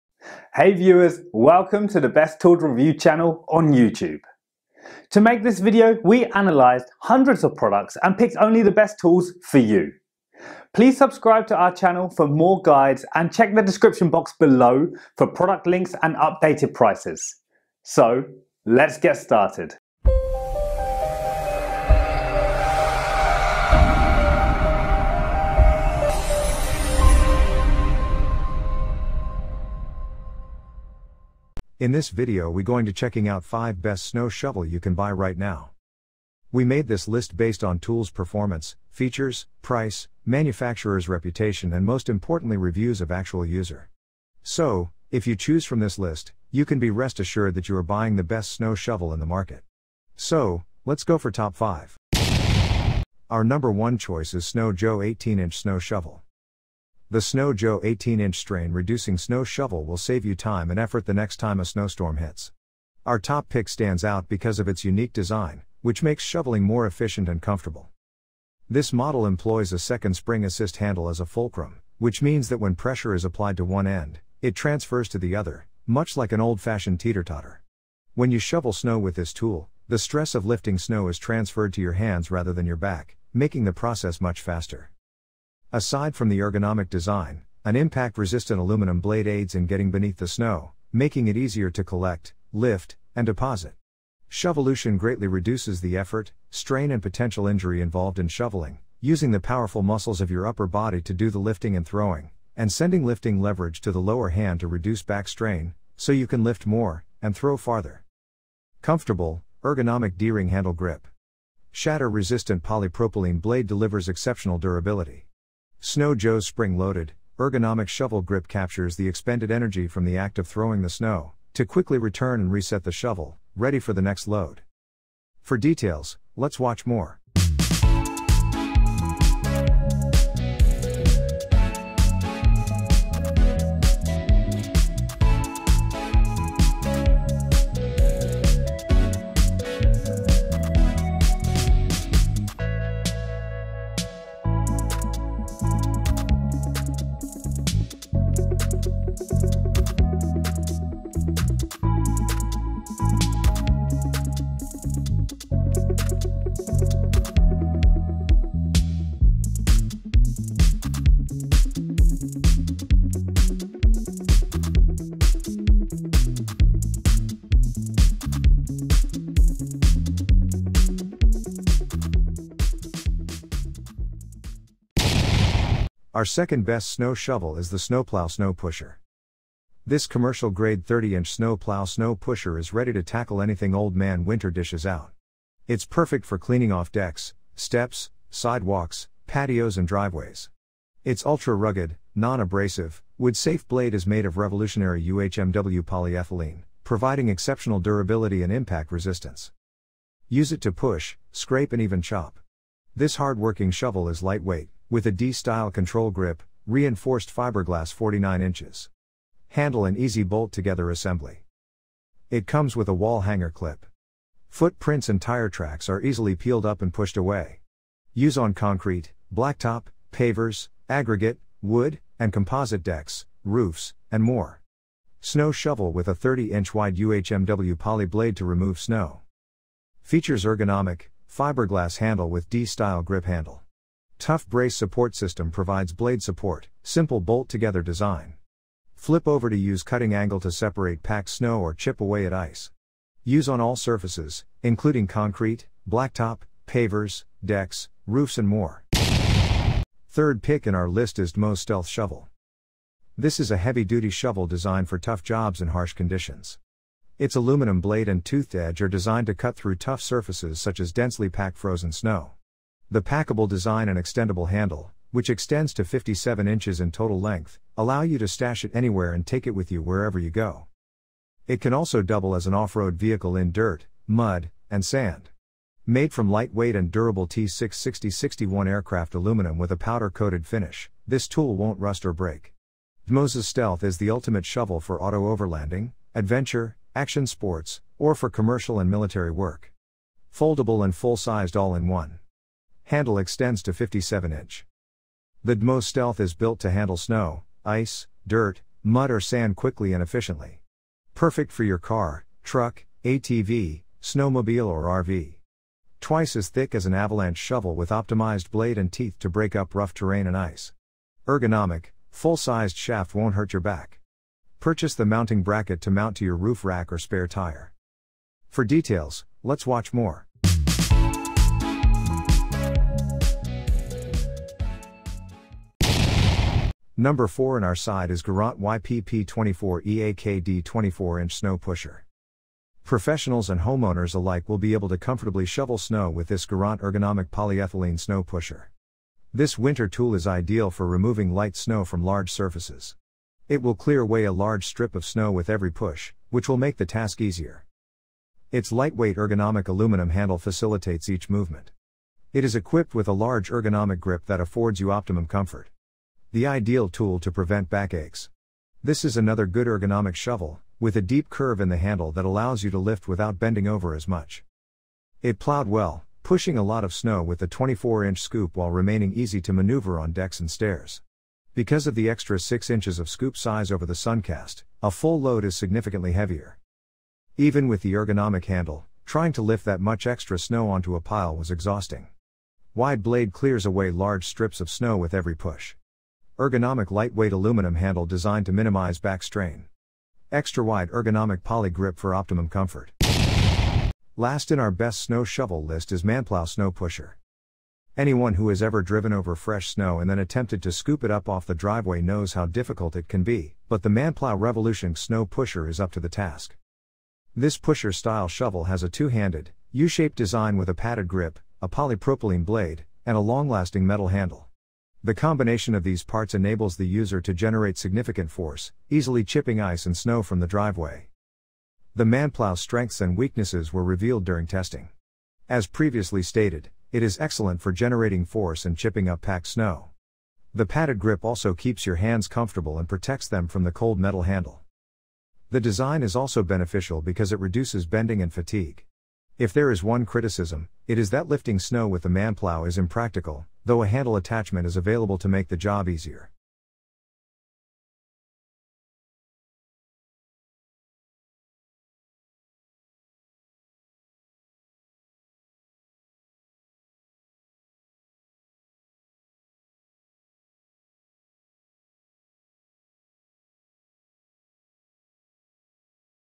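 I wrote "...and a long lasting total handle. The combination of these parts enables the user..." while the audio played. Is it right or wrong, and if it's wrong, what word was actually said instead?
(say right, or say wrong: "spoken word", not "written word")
wrong: "metal", not "total".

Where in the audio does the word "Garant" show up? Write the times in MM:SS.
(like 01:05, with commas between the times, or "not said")
05:28, 05:36.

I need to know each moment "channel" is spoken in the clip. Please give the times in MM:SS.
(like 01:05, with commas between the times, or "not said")
00:02, 00:11.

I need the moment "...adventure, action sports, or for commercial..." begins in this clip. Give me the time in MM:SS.
04:46.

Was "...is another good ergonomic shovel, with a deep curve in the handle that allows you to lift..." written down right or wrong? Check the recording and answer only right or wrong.
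right.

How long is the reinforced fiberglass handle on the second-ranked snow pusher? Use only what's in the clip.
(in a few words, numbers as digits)
49 inches.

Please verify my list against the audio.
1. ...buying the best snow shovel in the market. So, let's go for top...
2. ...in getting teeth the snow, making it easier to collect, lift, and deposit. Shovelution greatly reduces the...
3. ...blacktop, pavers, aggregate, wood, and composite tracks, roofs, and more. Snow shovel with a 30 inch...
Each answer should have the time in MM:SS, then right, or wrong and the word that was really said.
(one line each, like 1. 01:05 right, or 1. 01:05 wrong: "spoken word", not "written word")
1. 00:47 right
2. 01:29 wrong: "beneath", not "teeth"
3. 03:39 wrong: "decks", not "tracks".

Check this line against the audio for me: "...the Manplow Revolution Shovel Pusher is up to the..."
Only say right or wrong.
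wrong.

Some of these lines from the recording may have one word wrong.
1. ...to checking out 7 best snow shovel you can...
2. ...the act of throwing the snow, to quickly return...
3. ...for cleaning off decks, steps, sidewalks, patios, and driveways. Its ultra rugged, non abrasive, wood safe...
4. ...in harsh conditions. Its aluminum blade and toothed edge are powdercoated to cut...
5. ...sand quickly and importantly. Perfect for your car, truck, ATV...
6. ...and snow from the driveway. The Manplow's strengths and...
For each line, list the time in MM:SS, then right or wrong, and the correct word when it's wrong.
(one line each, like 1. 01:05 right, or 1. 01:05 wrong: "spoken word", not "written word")
1. 00:32 wrong: "5", not "7"
2. 02:00 right
3. 03:06 right
4. 04:15 wrong: "designed", not "powdercoated"
5. 04:59 wrong: "efficiently", not "importantly"
6. 06:59 right.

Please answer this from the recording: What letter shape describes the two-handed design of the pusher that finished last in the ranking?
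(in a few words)
U shaped.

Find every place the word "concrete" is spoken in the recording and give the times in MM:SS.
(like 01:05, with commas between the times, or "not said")
03:38, 04:05.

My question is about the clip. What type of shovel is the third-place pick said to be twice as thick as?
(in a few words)
an avalanche shovel.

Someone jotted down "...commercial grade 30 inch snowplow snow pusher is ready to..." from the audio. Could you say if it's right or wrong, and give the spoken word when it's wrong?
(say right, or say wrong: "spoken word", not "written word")
right.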